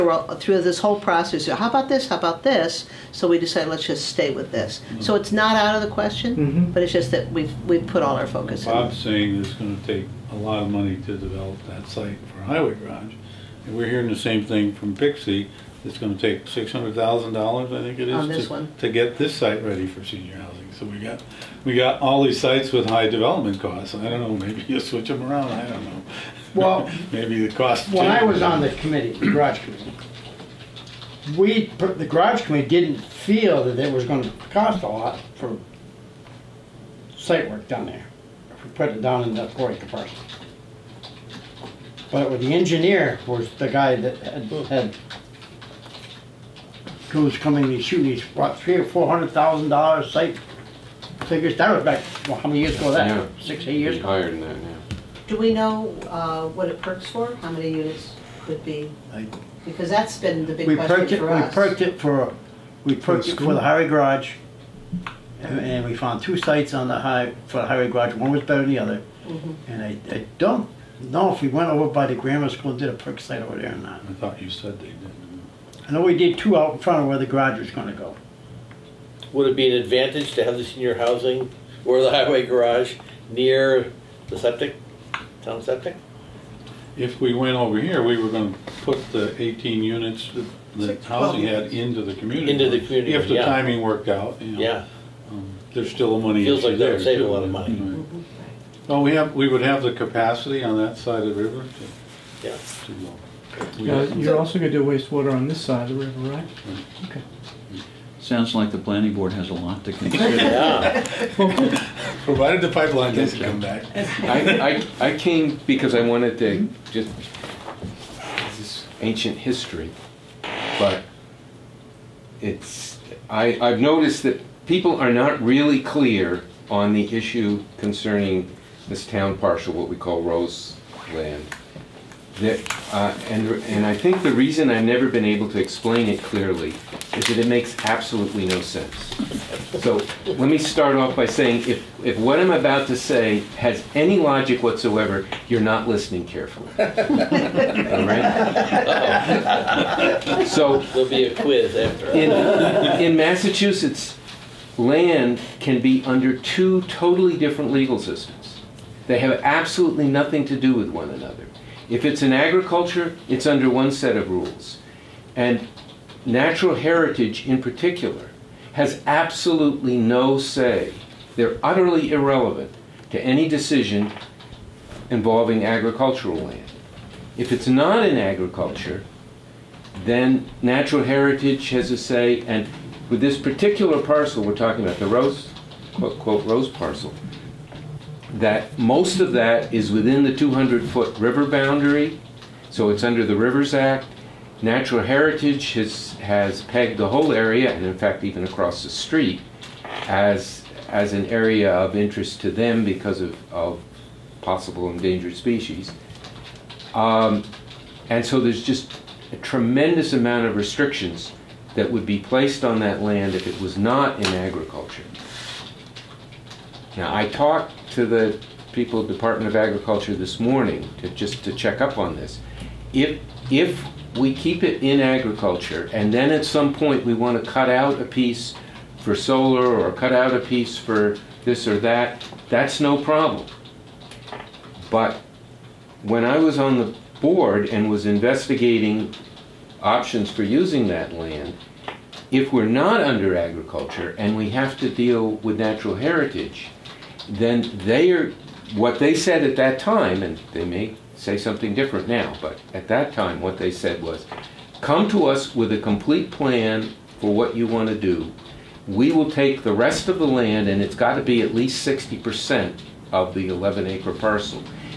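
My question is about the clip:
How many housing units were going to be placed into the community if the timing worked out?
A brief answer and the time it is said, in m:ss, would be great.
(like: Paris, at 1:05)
18, at 1:29.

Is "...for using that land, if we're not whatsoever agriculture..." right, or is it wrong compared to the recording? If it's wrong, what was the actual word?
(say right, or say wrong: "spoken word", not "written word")
wrong: "under", not "whatsoever".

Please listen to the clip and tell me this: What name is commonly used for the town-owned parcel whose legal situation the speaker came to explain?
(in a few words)
Rose Land.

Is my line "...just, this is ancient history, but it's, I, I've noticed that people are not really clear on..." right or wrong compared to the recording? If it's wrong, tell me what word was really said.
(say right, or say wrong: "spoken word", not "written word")
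right.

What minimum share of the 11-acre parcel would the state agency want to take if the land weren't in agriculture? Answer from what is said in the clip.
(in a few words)
60 percent.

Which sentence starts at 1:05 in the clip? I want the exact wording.
And, and we found two sites on the high, for the highway garage, one was better than the other.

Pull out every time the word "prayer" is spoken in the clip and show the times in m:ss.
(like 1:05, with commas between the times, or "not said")
not said.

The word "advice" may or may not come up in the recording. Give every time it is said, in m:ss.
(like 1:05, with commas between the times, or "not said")
not said.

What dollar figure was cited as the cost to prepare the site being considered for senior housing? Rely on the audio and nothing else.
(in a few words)
$600,000.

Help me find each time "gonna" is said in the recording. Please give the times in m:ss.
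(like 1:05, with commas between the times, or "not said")
0:09, 0:15, 0:34, 1:17, 1:28, 1:44.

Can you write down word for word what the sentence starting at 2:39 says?
They have absolutely nothing to do with one another.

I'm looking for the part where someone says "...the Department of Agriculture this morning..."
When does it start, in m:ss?
3:39.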